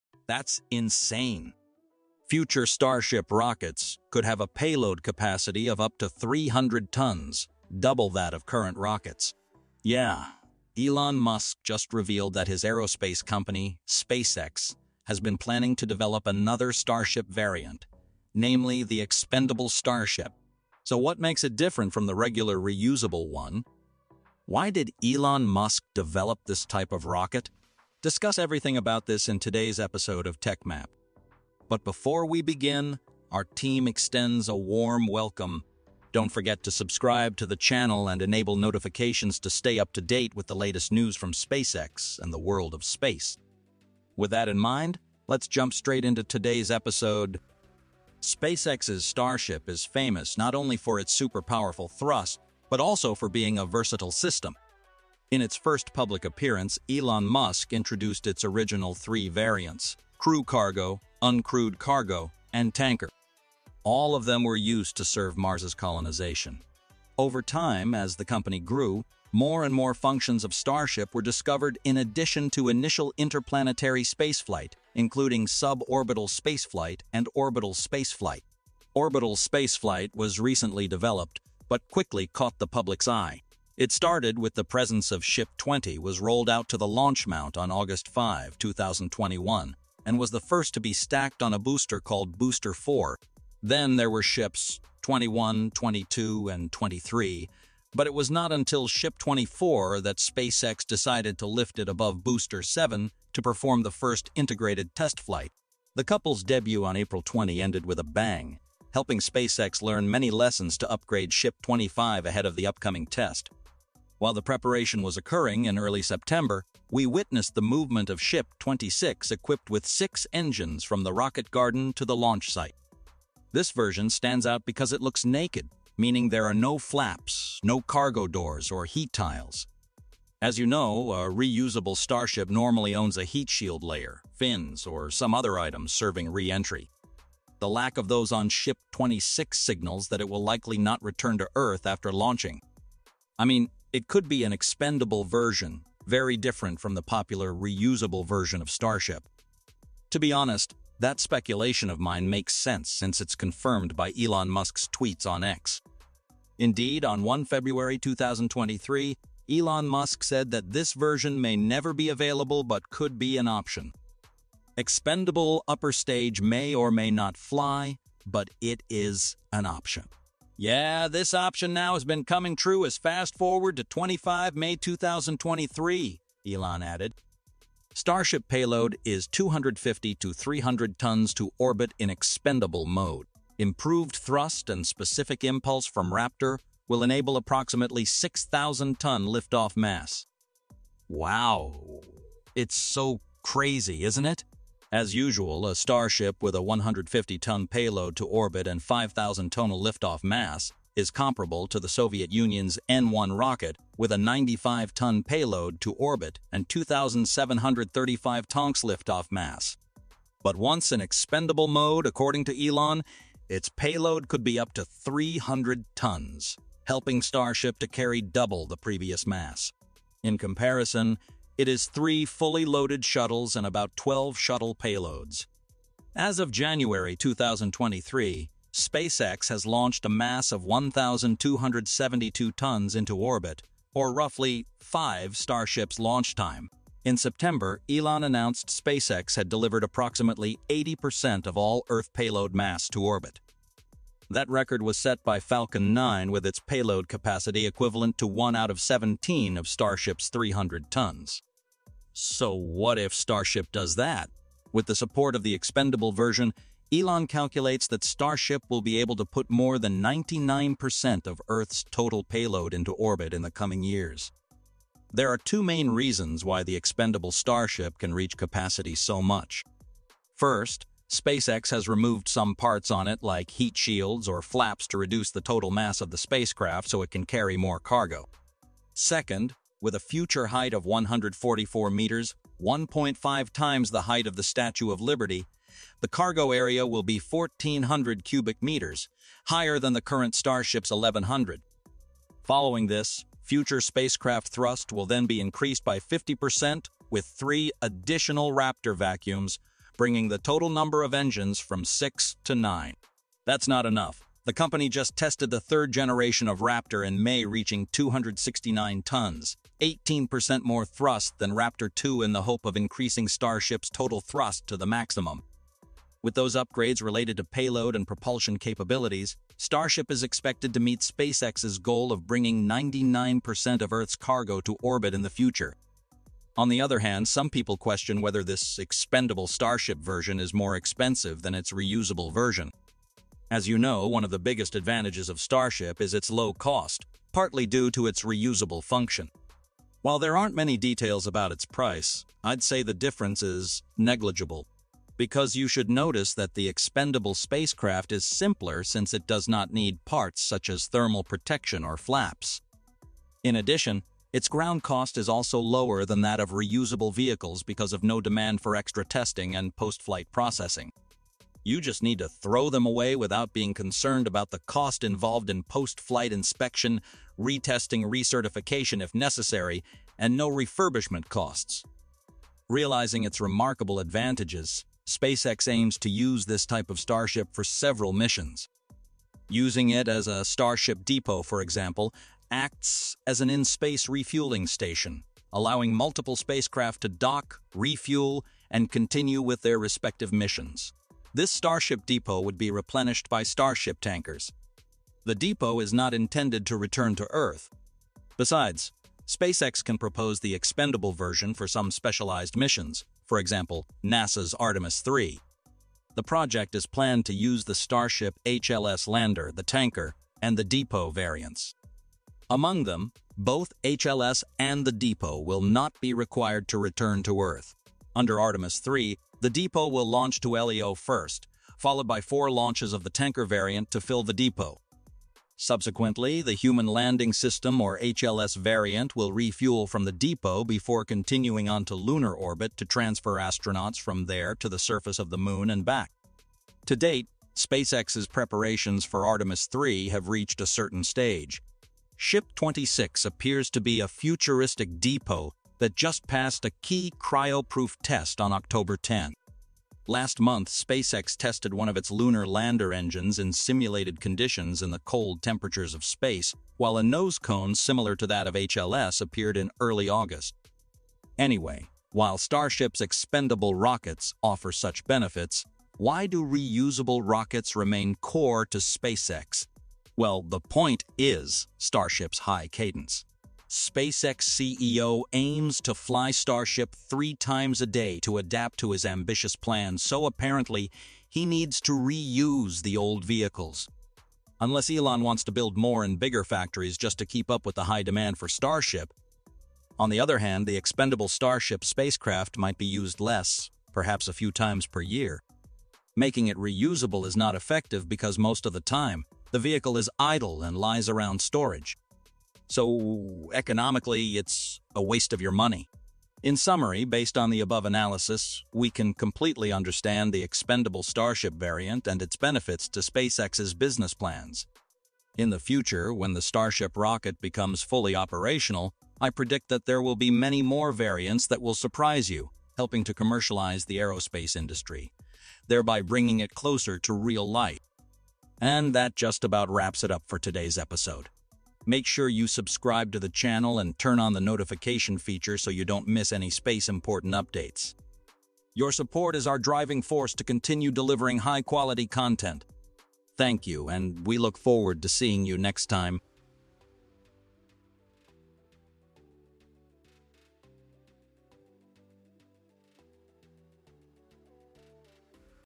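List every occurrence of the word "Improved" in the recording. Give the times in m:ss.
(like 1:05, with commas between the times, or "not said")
3:03.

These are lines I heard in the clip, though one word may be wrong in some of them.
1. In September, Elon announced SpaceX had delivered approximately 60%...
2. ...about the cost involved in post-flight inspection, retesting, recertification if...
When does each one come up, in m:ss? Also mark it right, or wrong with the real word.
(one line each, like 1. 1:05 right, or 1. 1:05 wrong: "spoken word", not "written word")
1. 3:57 wrong: "80", not "60"
2. 6:04 right.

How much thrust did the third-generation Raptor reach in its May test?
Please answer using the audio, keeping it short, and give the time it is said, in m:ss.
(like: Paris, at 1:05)
269 tons, at 5:07.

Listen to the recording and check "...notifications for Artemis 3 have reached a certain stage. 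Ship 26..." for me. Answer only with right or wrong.
wrong.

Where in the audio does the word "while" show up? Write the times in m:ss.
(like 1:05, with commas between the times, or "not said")
1:54, 5:40, 7:36, 7:42.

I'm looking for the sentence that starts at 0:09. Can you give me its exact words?
Yeah, Elon Musk just revealed that his aerospace company, SpaceX, has been planning to develop another Starship variant, namely the expendable Starship.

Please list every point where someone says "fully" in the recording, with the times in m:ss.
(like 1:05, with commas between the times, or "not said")
3:42, 8:37.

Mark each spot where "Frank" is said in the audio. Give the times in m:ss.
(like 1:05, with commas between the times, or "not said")
not said.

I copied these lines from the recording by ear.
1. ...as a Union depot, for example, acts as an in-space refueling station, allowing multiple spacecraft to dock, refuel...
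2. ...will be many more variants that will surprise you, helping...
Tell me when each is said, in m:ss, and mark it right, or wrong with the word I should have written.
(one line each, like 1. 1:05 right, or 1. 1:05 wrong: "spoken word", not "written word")
1. 6:20 wrong: "Starship", not "Union"
2. 8:40 right.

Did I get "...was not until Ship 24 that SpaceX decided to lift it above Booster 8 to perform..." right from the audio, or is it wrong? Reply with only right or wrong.
wrong.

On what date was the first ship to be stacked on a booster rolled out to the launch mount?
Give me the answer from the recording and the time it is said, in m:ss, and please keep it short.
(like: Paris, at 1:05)
August 5, 2021, at 1:27.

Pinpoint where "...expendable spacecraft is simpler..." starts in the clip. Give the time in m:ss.
5:46.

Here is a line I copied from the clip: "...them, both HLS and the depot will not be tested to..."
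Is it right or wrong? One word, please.
wrong.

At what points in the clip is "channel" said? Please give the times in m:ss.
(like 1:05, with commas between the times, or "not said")
0:37, 8:53.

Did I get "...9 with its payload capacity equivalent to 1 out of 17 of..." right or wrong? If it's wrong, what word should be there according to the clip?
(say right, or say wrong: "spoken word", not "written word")
right.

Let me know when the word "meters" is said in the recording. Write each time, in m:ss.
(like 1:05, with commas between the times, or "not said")
4:41, 4:48.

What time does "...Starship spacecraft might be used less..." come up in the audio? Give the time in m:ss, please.
8:11.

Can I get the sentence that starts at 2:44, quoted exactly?
Expendable upper stage may or may not fly, but it is an option.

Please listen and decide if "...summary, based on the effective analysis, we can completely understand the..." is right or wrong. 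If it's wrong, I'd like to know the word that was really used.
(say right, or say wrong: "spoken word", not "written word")
wrong: "above", not "effective".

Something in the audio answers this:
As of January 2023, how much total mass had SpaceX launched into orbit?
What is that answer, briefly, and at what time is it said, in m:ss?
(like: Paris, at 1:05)
1,272 tons, at 3:50.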